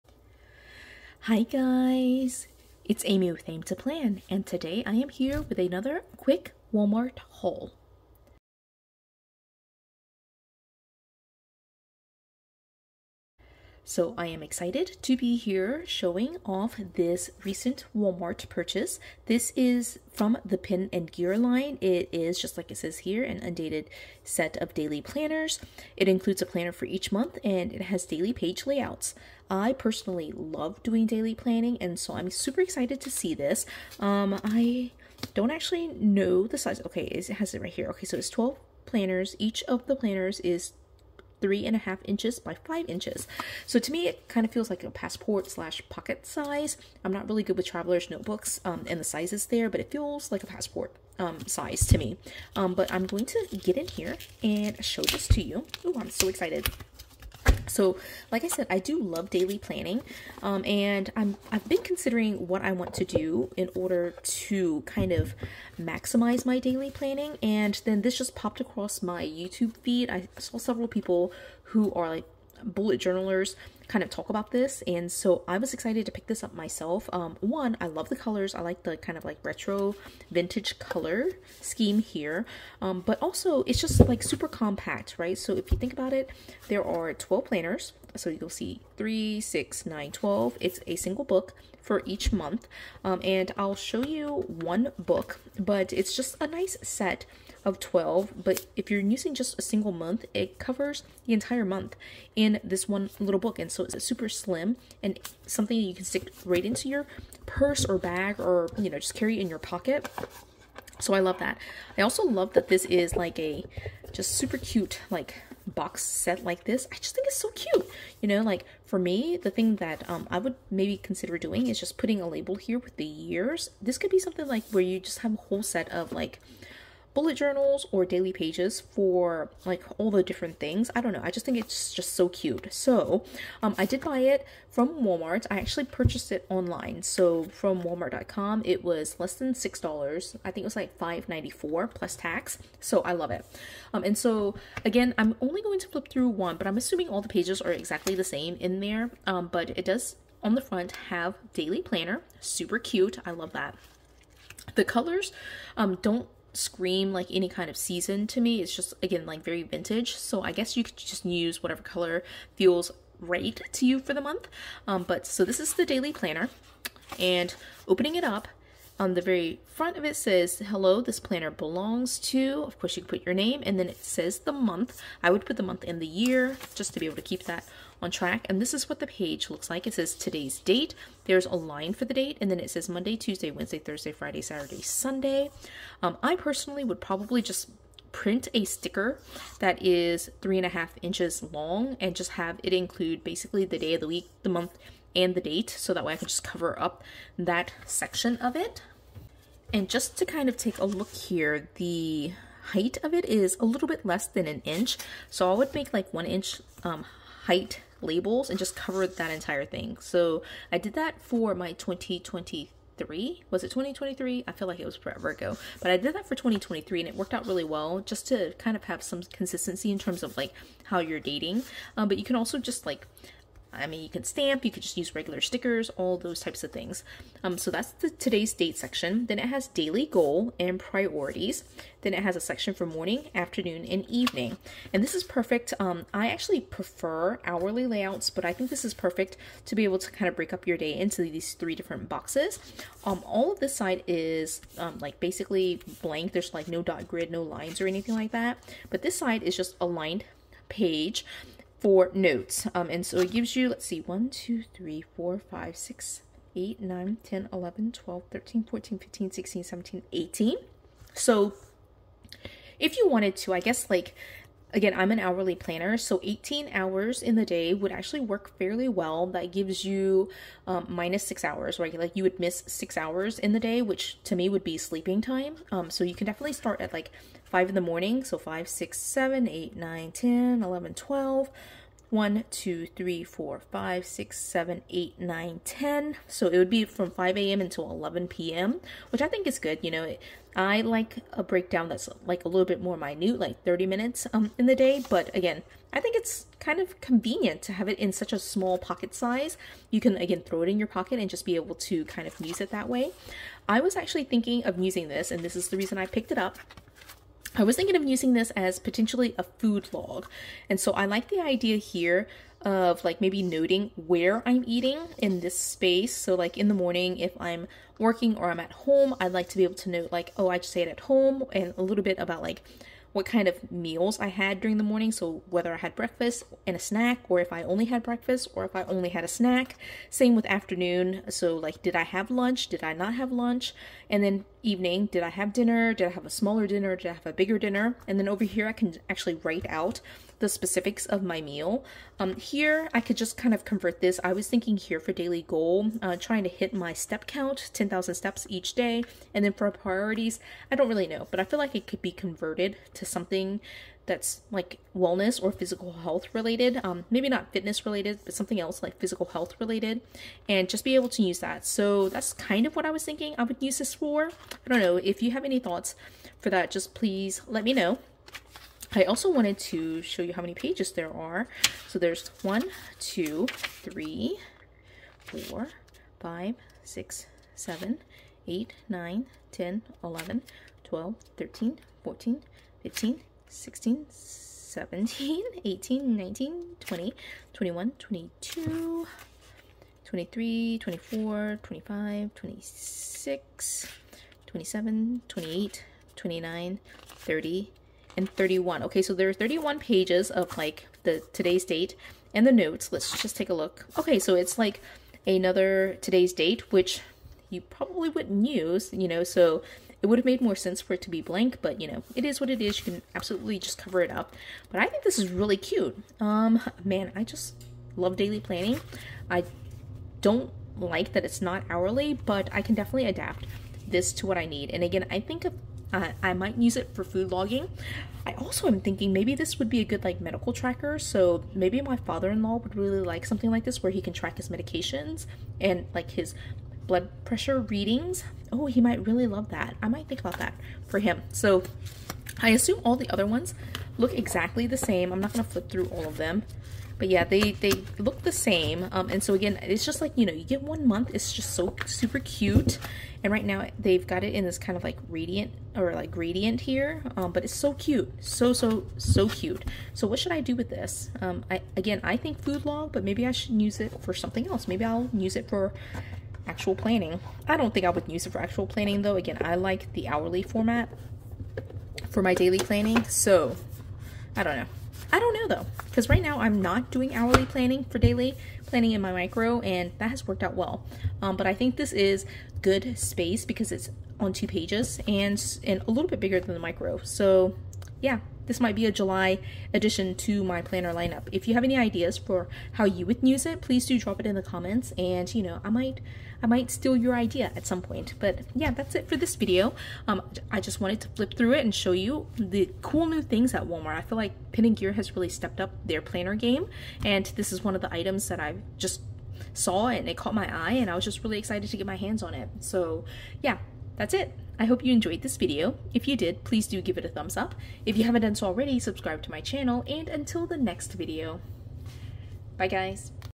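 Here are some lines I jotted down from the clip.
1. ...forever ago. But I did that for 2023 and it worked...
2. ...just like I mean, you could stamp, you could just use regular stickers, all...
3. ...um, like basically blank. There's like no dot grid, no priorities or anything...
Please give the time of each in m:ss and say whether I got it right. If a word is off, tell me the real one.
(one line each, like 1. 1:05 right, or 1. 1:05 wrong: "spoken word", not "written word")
1. 3:34 right
2. 3:42 right
3. 4:04 wrong: "lines", not "priorities".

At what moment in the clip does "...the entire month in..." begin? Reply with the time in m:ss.
1:41.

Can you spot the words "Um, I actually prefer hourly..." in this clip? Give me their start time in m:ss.
3:55.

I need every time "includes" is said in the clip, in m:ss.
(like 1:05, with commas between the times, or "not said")
0:26, 3:12.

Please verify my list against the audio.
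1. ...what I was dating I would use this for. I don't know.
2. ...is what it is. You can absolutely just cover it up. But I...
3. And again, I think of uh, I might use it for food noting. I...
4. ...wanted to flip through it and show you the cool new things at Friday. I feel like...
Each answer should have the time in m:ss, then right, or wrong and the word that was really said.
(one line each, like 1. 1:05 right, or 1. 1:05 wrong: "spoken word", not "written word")
1. 6:02 wrong: "thinking", not "dating"
2. 6:52 right
3. 7:04 wrong: "logging", not "noting"
4. 8:20 wrong: "Walmart", not "Friday".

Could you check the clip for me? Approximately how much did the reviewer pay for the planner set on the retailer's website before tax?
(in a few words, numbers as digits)
$5.94.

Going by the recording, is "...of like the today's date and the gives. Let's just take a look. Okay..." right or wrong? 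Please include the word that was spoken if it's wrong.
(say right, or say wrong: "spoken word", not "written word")
wrong: "notes", not "gives".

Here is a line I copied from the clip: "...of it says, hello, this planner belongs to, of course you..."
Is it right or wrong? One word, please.
right.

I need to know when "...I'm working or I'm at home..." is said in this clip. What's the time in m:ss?
5:17.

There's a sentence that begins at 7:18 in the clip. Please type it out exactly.
Oh, he might really love that.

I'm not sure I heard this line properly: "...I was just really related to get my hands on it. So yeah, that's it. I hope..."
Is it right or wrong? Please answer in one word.
wrong.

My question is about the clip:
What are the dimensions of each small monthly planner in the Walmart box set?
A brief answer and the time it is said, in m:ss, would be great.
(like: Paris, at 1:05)
3.5 x 5 inches, at 0:41.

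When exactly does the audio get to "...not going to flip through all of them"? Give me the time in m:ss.
7:25.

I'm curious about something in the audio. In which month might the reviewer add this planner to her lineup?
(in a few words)
July.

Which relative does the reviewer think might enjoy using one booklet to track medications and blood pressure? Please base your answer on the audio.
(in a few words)
father-in-law.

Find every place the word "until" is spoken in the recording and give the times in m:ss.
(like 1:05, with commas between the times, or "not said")
4:47, 8:40.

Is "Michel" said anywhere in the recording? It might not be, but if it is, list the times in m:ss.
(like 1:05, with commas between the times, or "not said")
not said.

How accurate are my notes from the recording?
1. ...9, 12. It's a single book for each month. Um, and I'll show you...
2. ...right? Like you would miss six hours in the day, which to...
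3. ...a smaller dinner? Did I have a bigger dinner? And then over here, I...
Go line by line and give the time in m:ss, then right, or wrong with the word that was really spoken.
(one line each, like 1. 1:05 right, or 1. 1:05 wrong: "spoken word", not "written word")
1. 1:29 right
2. 4:31 right
3. 5:36 right.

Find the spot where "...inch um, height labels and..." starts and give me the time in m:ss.
3:26.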